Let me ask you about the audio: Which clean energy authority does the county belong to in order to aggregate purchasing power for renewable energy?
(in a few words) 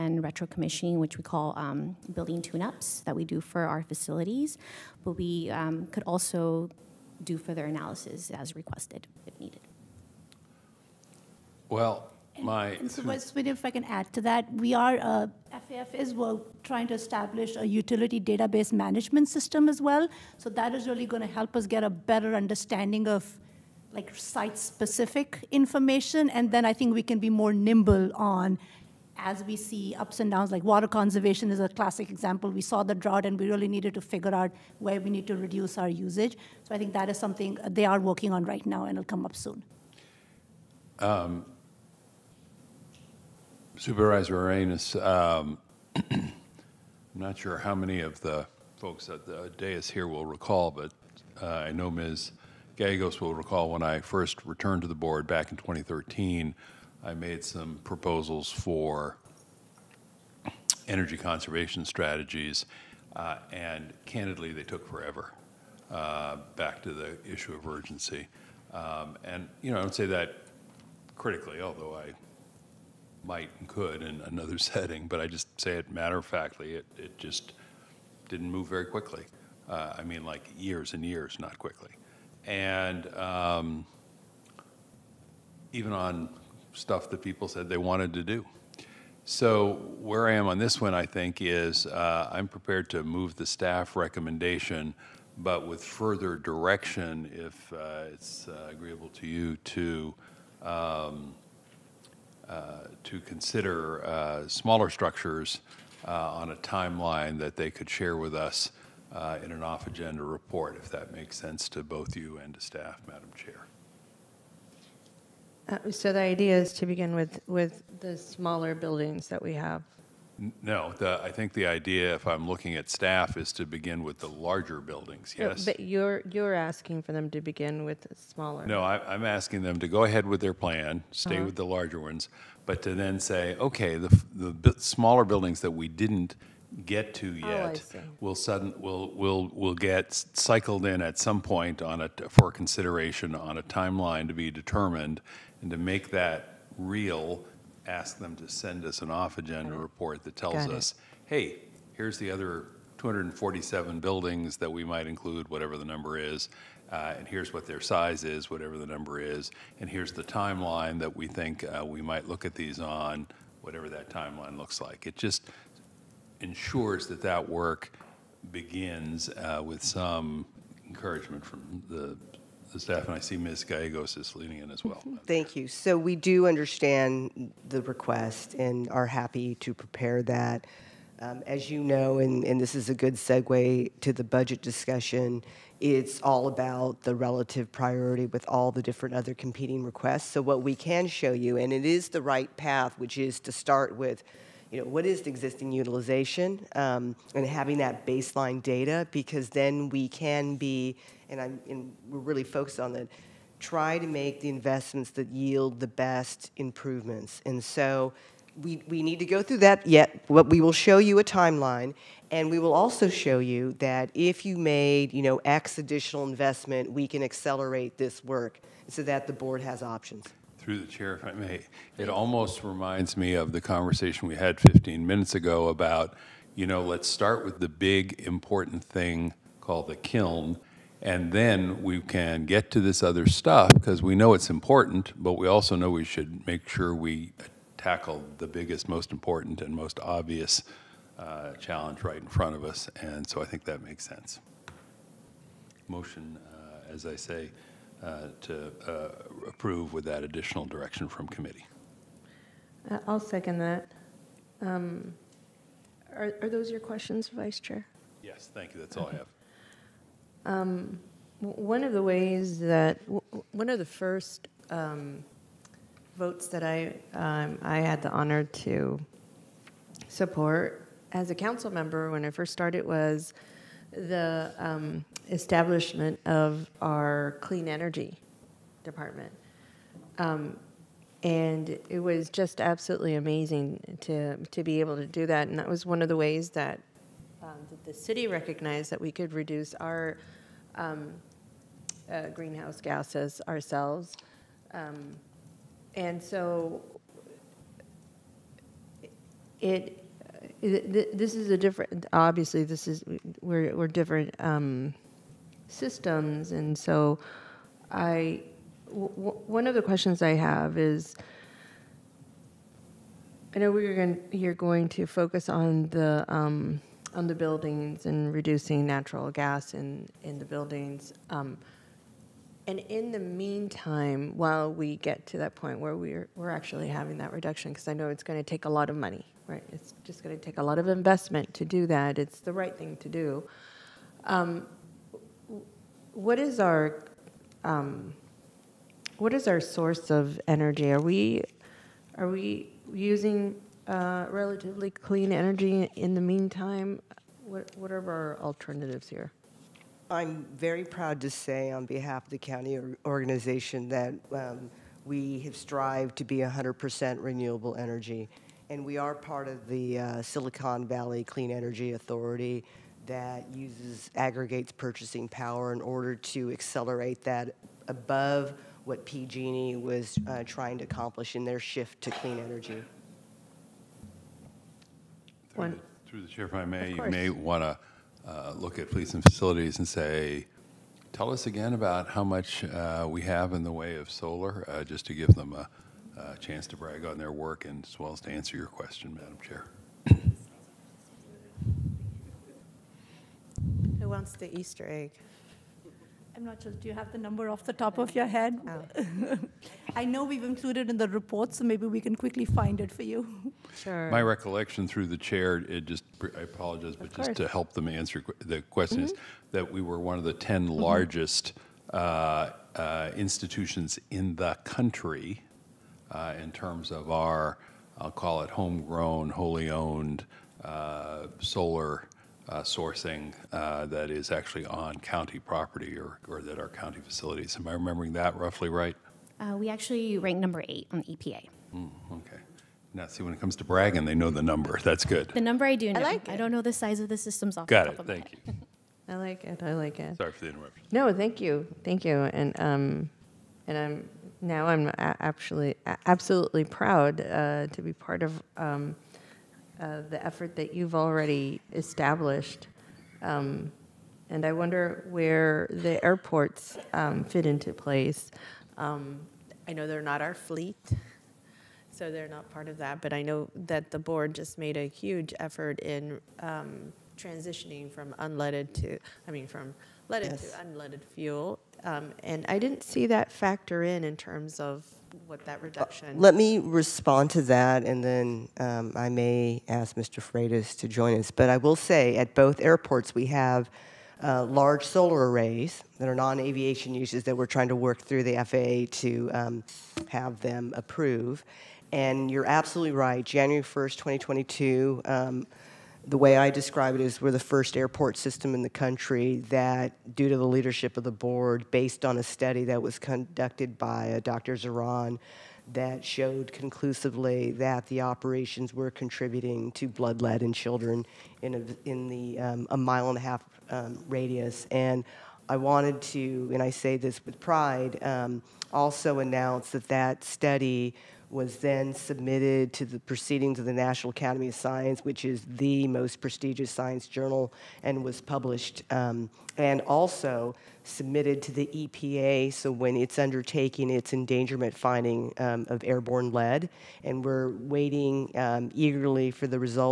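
Silicon Valley Clean Energy Authority.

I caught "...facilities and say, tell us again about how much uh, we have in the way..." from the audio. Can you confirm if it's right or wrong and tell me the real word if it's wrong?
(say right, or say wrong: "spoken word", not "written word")
right.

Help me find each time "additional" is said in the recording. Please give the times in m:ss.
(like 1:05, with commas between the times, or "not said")
3:35, 4:10.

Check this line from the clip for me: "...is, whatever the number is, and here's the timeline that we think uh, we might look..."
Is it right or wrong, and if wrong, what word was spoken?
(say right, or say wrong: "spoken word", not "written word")
right.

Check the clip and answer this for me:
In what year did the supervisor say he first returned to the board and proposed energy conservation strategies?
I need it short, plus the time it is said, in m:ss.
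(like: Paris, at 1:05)
2013, at 0:55.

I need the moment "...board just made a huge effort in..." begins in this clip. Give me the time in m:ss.
7:43.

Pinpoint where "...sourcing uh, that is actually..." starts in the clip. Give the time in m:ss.
7:02.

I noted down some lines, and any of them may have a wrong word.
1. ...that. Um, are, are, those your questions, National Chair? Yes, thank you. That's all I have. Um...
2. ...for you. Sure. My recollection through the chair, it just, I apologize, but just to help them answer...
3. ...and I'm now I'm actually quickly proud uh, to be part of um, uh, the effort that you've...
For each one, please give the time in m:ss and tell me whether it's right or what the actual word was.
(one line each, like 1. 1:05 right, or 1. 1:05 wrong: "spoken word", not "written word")
1. 4:13 wrong: "Vice", not "National"
2. 6:42 right
3. 7:23 wrong: "absolutely", not "quickly".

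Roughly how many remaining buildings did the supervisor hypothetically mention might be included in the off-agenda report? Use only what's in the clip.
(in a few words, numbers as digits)
247.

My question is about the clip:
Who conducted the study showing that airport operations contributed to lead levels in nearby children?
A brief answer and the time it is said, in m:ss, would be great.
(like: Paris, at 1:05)
Dr. Zahran, at 8:24.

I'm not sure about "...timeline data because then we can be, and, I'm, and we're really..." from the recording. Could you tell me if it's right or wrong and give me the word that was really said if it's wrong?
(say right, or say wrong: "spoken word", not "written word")
wrong: "baseline", not "timeline".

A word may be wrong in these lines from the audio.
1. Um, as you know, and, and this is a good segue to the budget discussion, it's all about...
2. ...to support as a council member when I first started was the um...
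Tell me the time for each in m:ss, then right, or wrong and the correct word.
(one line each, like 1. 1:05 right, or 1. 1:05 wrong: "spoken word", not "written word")
1. 3:01 right
2. 4:28 right.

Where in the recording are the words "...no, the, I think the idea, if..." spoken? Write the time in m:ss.
2:00.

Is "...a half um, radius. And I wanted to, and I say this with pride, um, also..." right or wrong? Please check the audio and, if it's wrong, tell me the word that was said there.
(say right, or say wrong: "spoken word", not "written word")
right.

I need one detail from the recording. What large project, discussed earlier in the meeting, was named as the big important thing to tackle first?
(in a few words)
the kiln.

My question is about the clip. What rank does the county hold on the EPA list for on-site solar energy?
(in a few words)
8.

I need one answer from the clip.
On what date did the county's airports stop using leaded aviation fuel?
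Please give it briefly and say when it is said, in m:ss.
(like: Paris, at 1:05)
January 1st, 2022, at 8:13.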